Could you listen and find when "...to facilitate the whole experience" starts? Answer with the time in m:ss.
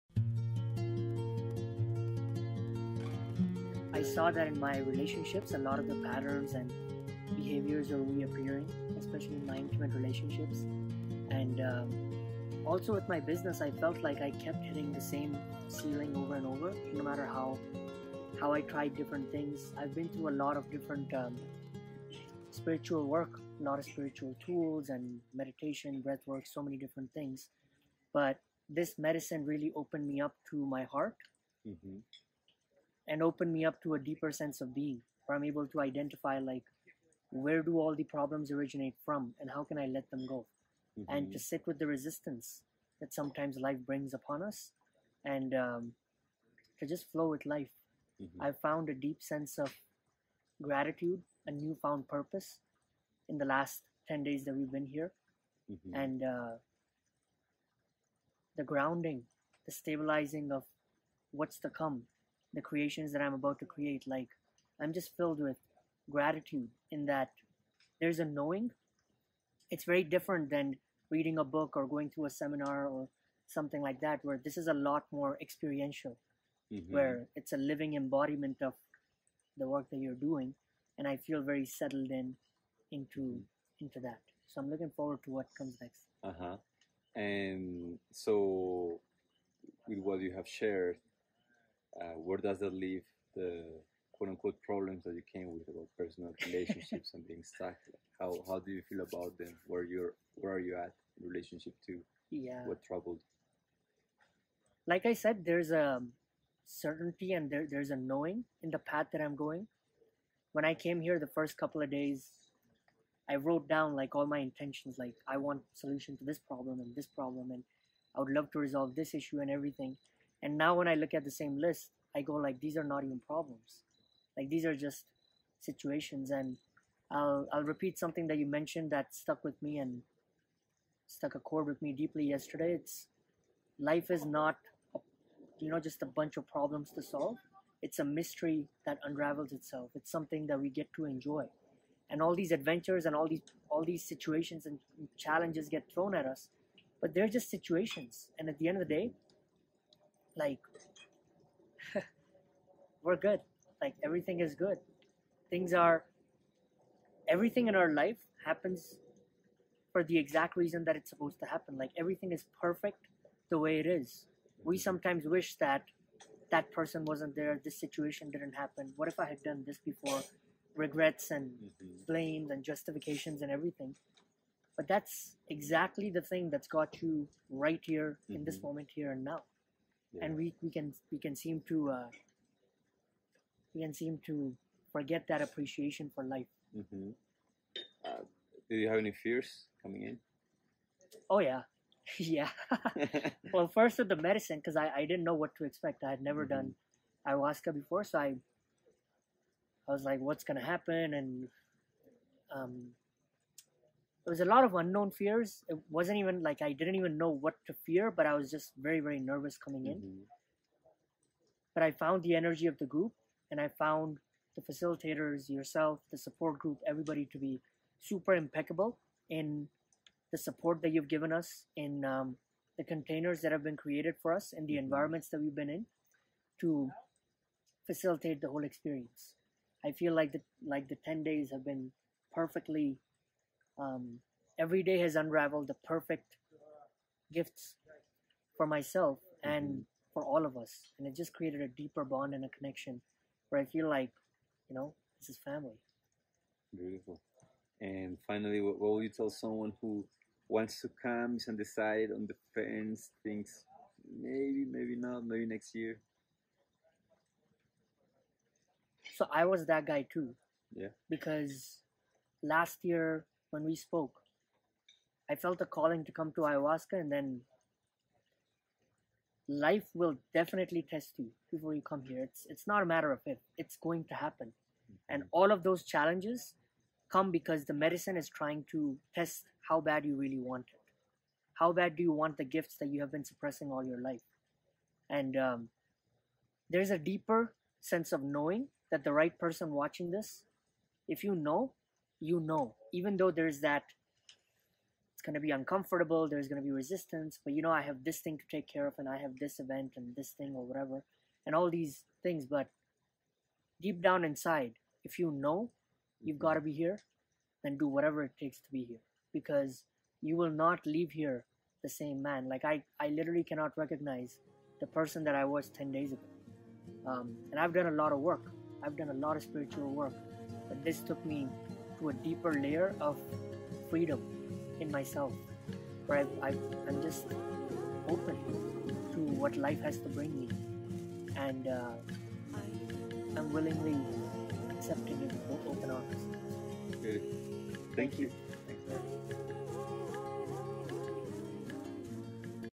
3:46.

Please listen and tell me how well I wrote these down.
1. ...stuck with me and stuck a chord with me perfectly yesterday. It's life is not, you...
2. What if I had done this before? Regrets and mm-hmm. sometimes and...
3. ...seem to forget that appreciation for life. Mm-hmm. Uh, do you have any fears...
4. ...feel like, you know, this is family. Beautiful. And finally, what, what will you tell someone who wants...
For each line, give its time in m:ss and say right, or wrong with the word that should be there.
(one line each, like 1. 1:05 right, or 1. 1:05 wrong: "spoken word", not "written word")
1. 2:09 wrong: "deeply", not "perfectly"
2. 2:48 wrong: "blames", not "sometimes"
3. 3:03 right
4. 4:03 right.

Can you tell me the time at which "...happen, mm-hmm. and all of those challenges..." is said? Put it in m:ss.
4:34.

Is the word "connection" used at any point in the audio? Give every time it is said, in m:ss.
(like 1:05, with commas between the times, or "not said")
4:02.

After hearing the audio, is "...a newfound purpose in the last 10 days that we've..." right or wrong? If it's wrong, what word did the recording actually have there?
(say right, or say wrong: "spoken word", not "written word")
right.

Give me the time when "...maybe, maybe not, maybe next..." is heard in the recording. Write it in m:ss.
4:14.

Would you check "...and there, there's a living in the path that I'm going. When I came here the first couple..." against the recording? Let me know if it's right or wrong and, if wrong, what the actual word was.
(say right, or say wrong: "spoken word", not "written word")
wrong: "knowing", not "living".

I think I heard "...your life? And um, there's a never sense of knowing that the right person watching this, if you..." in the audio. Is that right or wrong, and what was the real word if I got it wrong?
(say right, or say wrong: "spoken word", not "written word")
wrong: "deeper", not "never".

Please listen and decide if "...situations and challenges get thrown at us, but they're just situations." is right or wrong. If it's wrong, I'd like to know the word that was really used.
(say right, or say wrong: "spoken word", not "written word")
right.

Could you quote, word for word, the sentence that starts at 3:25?
It wasn't even like I didn't even know what to fear, but I was just very, very nervous coming in.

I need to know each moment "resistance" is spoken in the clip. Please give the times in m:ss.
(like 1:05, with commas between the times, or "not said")
0:41, 4:56.